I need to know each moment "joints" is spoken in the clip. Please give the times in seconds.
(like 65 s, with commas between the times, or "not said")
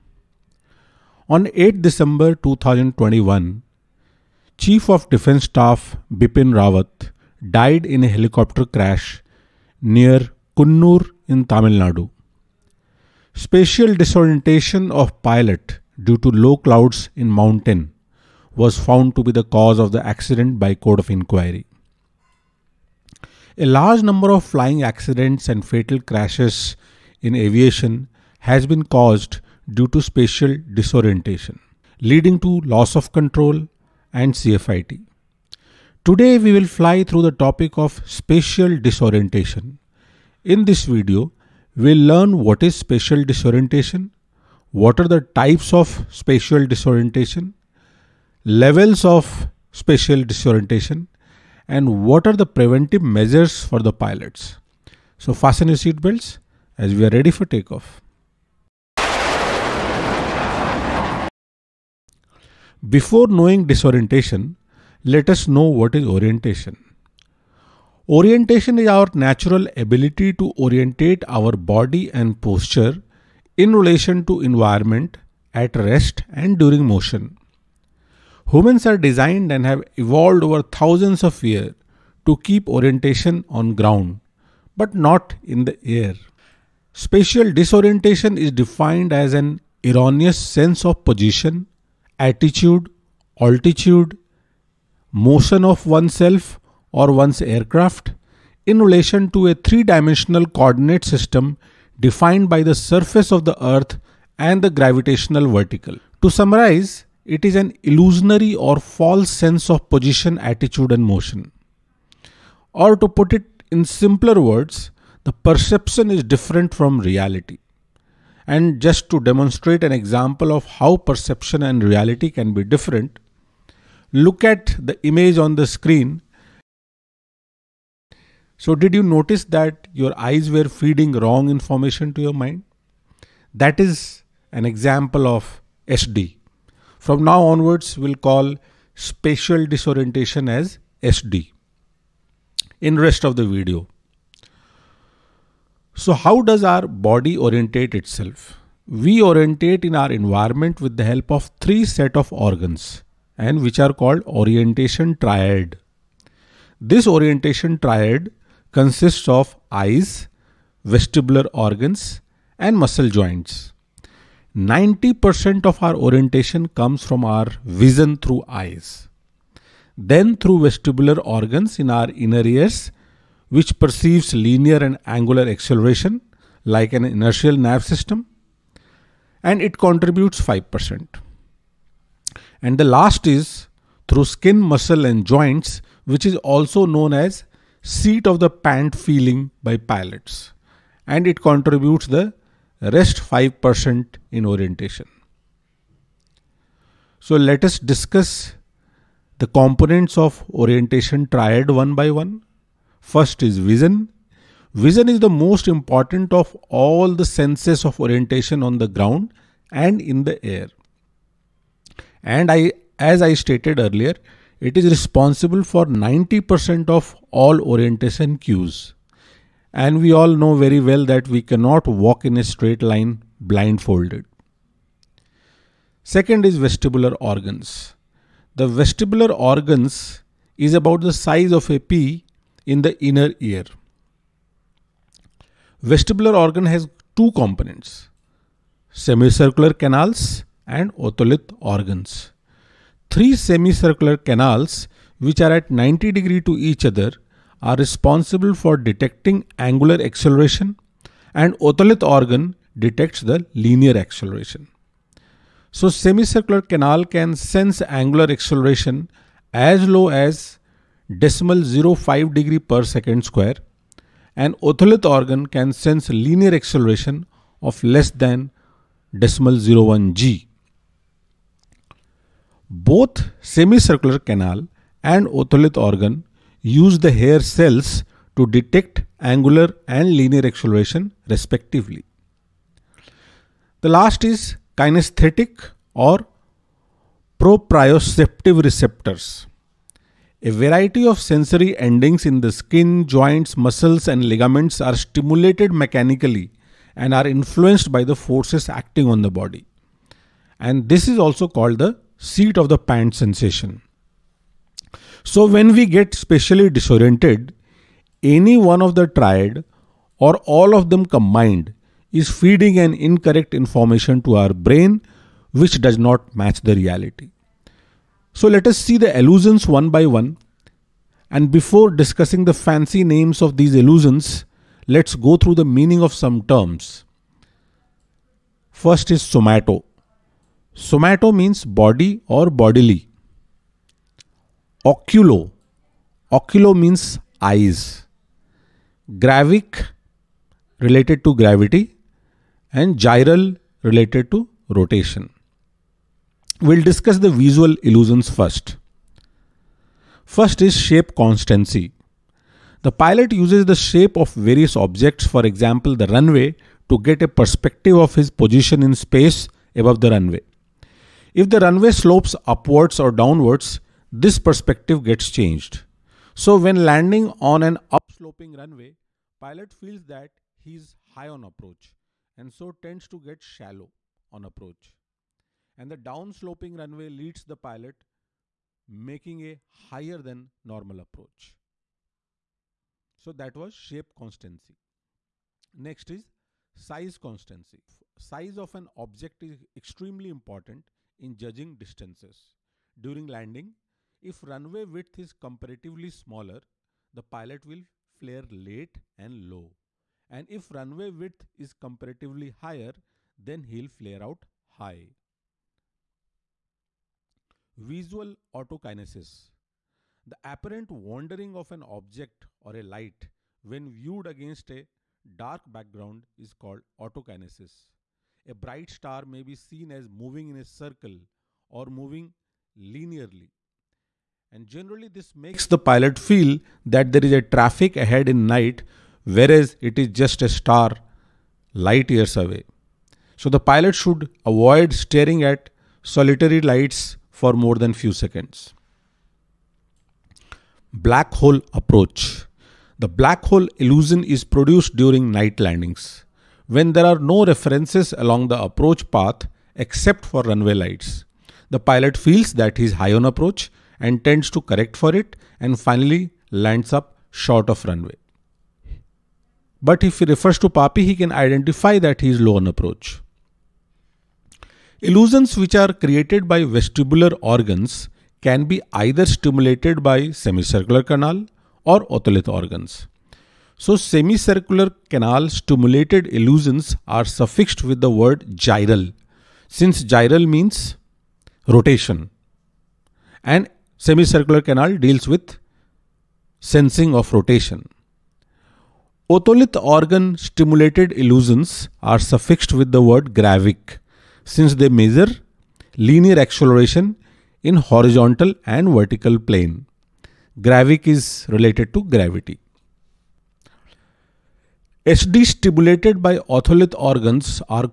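163 s, 185 s, 293 s.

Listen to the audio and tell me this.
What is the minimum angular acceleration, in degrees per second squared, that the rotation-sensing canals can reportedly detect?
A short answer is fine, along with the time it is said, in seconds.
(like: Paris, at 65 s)
0.5, at 261 s.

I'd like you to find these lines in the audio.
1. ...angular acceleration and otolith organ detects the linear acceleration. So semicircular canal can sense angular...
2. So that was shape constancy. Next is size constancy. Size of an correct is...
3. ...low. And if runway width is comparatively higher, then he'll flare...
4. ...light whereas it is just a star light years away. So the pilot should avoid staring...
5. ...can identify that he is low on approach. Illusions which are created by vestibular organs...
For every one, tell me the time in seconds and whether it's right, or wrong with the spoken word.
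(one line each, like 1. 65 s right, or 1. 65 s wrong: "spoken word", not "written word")
1. 249 s right
2. 383 s wrong: "object", not "correct"
3. 399 s right
4. 428 s wrong: "night", not "light"
5. 461 s right.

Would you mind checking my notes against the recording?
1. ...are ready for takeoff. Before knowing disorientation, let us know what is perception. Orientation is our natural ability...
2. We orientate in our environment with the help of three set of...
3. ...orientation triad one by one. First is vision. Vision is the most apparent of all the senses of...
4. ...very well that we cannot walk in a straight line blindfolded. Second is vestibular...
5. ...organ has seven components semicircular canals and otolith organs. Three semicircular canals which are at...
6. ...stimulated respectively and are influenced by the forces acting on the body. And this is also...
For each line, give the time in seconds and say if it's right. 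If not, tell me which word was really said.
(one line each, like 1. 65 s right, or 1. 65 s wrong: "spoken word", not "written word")
1. 57 s wrong: "orientation", not "perception"
2. 148 s right
3. 200 s wrong: "important", not "apparent"
4. 220 s right
5. 236 s wrong: "two", not "seven"
6. 294 s wrong: "mechanically", not "respectively".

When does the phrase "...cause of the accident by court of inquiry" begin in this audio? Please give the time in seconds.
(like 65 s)
19 s.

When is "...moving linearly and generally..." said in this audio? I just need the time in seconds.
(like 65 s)
421 s.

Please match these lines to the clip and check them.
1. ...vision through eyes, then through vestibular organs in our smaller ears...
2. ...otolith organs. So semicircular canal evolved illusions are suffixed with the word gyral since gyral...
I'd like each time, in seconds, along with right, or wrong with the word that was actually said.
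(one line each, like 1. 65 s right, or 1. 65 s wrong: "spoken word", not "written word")
1. 167 s wrong: "inner", not "smaller"
2. 472 s wrong: "stimulated", not "evolved".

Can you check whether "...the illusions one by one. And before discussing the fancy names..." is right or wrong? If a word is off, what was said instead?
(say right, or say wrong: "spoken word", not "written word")
right.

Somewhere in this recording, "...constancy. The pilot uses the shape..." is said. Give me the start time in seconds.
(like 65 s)
351 s.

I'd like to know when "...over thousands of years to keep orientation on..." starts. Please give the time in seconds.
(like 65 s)
80 s.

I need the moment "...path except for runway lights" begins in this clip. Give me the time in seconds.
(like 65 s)
449 s.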